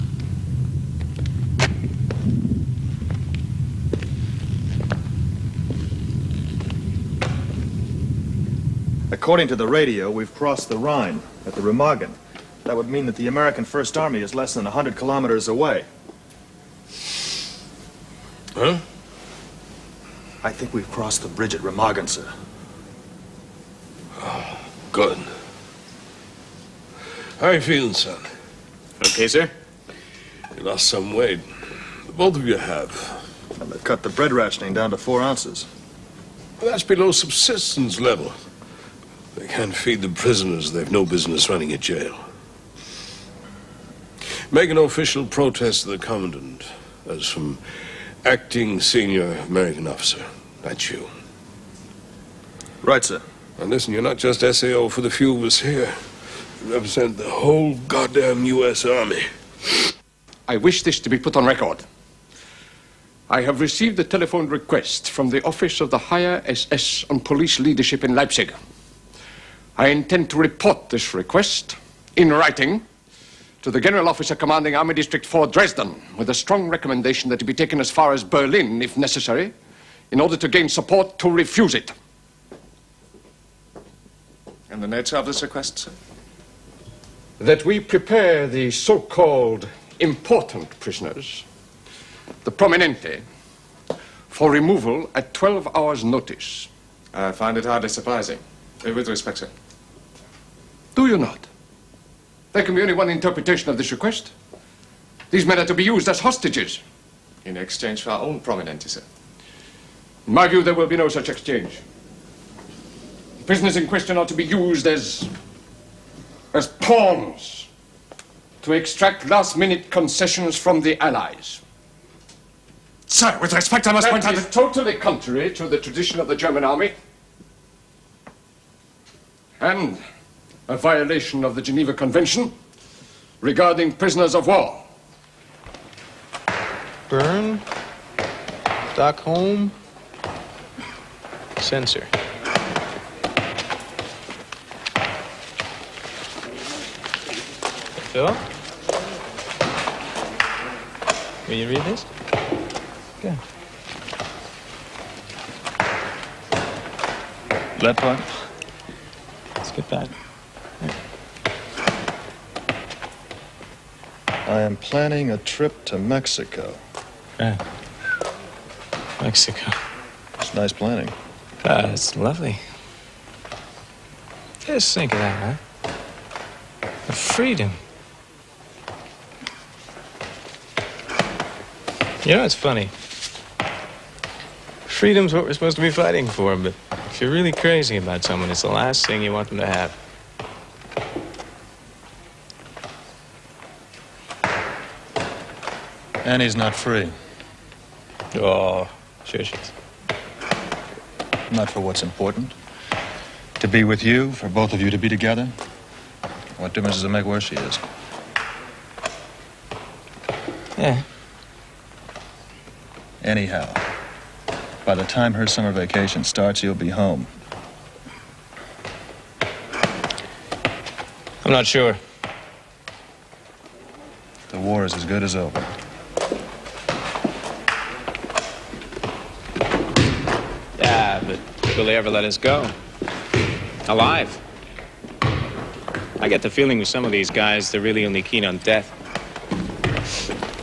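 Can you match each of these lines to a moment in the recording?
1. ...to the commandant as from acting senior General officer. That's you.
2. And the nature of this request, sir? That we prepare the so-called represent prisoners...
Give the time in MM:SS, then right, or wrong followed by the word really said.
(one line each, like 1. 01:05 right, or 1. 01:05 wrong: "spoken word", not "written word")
1. 00:45 wrong: "American", not "General"
2. 01:24 wrong: "important", not "represent".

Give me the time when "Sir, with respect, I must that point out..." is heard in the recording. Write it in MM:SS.
02:03.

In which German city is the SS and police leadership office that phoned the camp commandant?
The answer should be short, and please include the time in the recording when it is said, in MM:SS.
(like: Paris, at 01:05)
Leipzig, at 01:08.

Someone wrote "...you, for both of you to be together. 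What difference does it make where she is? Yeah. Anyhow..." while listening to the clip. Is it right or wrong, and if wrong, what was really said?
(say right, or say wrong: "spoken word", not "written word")
right.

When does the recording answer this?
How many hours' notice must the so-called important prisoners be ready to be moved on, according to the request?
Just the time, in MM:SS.
01:35.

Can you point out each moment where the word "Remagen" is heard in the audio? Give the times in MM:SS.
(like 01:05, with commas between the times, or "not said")
00:11, 00:21.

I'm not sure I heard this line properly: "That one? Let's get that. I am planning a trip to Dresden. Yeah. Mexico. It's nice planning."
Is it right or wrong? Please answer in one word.
wrong.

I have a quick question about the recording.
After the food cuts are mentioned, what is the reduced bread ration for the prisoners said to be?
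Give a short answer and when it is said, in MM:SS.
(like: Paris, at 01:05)
4 ounces, at 00:34.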